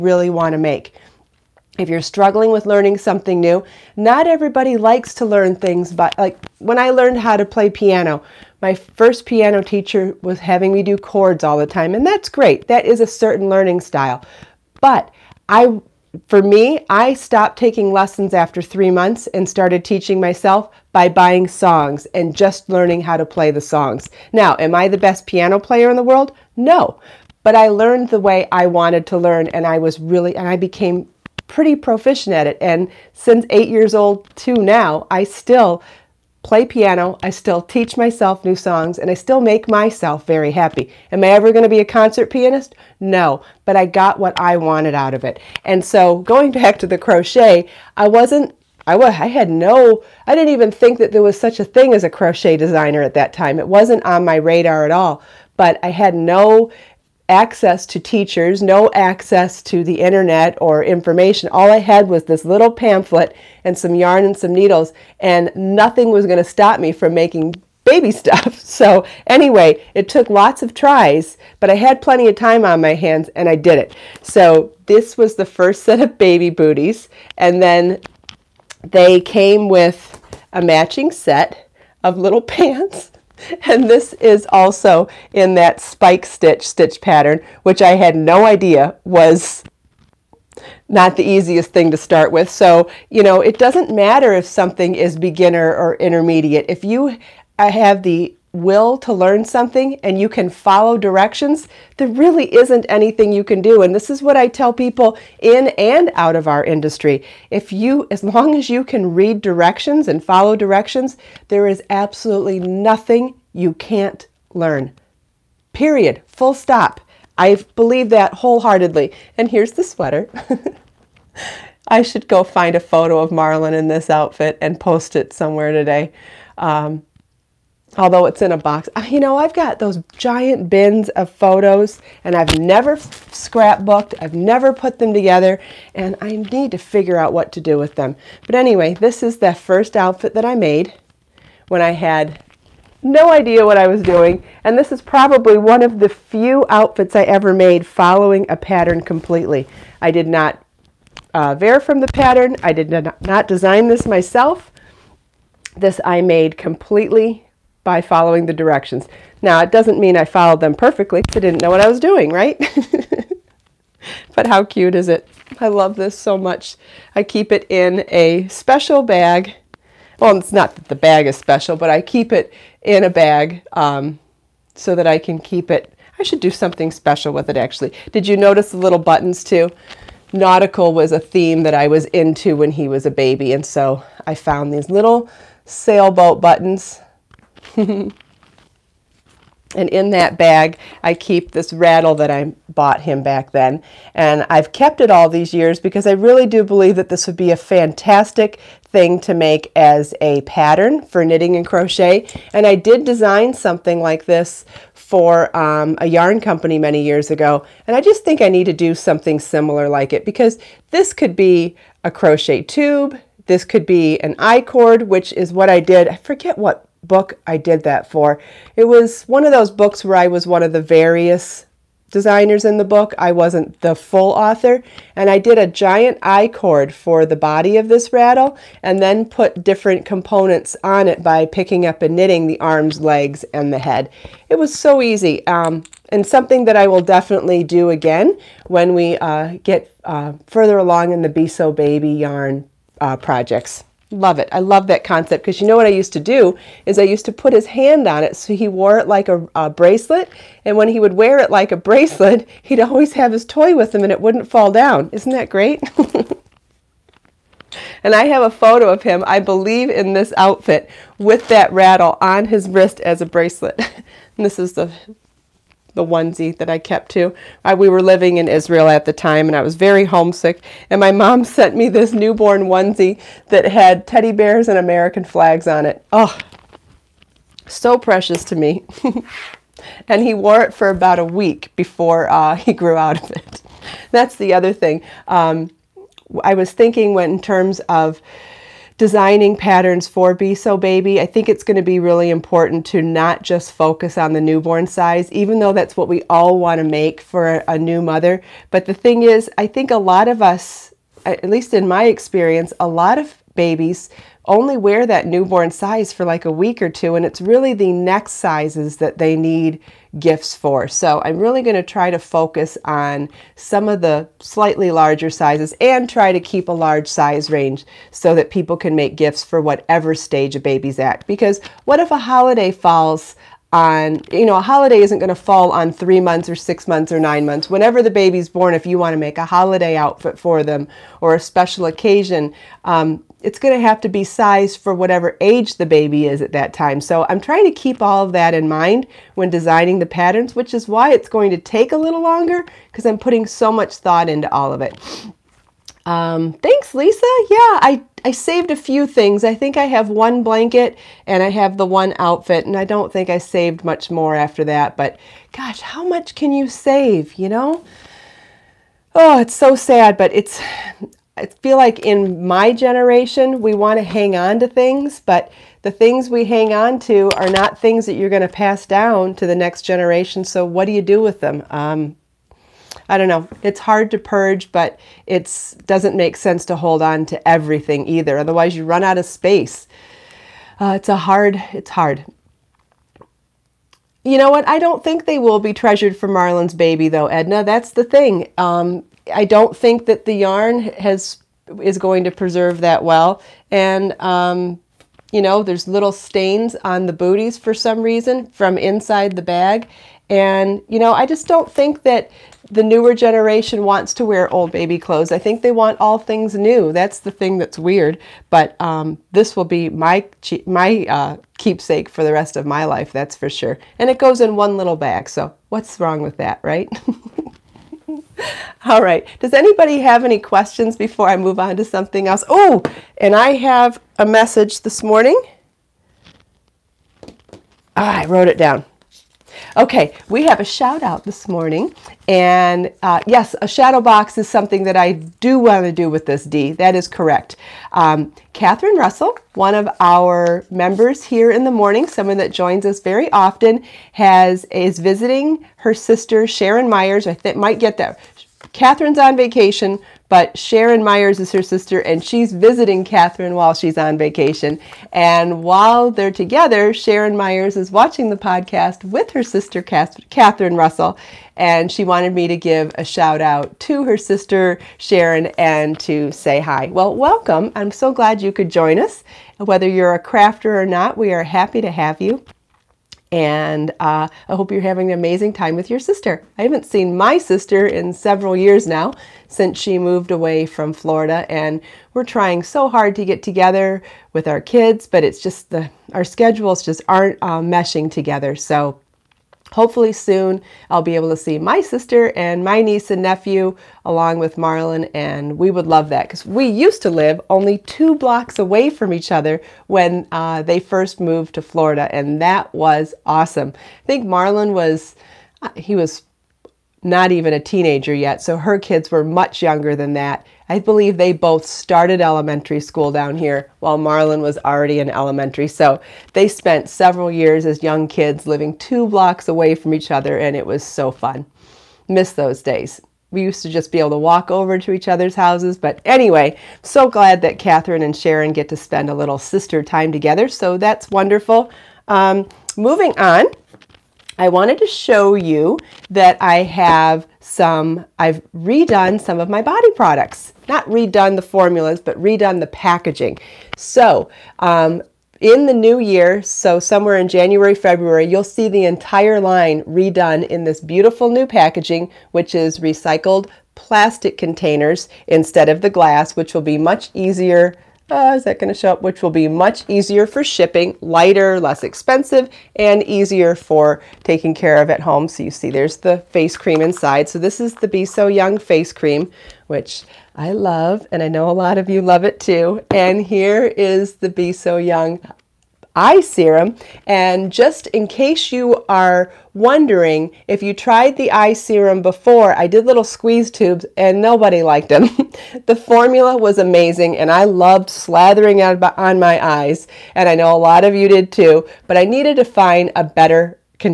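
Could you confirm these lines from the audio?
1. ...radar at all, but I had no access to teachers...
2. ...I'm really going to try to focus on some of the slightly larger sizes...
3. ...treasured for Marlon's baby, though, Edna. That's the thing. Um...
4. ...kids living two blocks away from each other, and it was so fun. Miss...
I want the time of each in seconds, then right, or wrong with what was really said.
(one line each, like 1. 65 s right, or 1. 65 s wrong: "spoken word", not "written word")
1. 54 s right
2. 311 s right
3. 385 s right
4. 518 s right.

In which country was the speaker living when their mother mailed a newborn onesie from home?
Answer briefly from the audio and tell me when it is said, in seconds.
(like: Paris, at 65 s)
Israel, at 268 s.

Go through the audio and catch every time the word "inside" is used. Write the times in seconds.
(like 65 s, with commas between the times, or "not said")
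398 s, 566 s.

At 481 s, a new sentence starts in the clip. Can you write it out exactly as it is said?
And we're trying so hard to get together with our kids, but it's just the, our schedules just aren't uh, meshing together.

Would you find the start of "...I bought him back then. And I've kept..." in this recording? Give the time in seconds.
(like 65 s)
192 s.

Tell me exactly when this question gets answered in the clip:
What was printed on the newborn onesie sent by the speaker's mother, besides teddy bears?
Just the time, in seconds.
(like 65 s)
274 s.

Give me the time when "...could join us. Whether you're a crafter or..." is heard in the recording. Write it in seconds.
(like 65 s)
468 s.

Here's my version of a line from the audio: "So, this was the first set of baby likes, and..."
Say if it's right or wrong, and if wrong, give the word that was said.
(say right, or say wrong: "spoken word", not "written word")
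wrong: "booties", not "likes".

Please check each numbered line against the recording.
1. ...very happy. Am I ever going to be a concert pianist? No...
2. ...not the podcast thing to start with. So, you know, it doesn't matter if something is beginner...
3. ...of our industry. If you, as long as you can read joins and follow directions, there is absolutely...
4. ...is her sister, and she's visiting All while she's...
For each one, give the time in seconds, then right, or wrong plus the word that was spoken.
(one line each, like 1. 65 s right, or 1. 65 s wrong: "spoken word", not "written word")
1. 40 s right
2. 90 s wrong: "easiest", not "podcast"
3. 106 s wrong: "directions", not "joins"
4. 451 s wrong: "Catherine", not "All".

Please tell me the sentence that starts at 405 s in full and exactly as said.
I think they want all things new.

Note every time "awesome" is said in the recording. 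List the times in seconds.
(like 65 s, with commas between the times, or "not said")
503 s.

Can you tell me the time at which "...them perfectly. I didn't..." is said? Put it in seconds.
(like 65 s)
160 s.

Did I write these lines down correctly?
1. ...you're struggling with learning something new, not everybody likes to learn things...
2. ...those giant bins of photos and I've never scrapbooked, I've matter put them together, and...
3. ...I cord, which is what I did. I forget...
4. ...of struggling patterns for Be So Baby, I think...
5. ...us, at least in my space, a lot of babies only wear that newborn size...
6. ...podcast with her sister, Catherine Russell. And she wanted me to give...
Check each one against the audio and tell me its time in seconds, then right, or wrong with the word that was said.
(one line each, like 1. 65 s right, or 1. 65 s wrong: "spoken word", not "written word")
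1. 1 s right
2. 129 s wrong: "never", not "matter"
3. 214 s right
4. 287 s wrong: "designing", not "struggling"
5. 300 s wrong: "experience", not "space"
6. 458 s right.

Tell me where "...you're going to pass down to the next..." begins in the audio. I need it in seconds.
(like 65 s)
368 s.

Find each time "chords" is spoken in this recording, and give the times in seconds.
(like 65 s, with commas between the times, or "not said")
10 s.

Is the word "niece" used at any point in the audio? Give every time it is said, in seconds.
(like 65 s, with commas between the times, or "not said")
492 s.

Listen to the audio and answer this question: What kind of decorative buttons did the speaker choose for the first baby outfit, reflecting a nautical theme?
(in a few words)
Sailboat buttons.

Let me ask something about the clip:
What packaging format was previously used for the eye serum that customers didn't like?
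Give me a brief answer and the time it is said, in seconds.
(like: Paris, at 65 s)
Squeeze tubes, at 583 s.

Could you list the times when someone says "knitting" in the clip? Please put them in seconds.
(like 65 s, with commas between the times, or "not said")
201 s, 232 s.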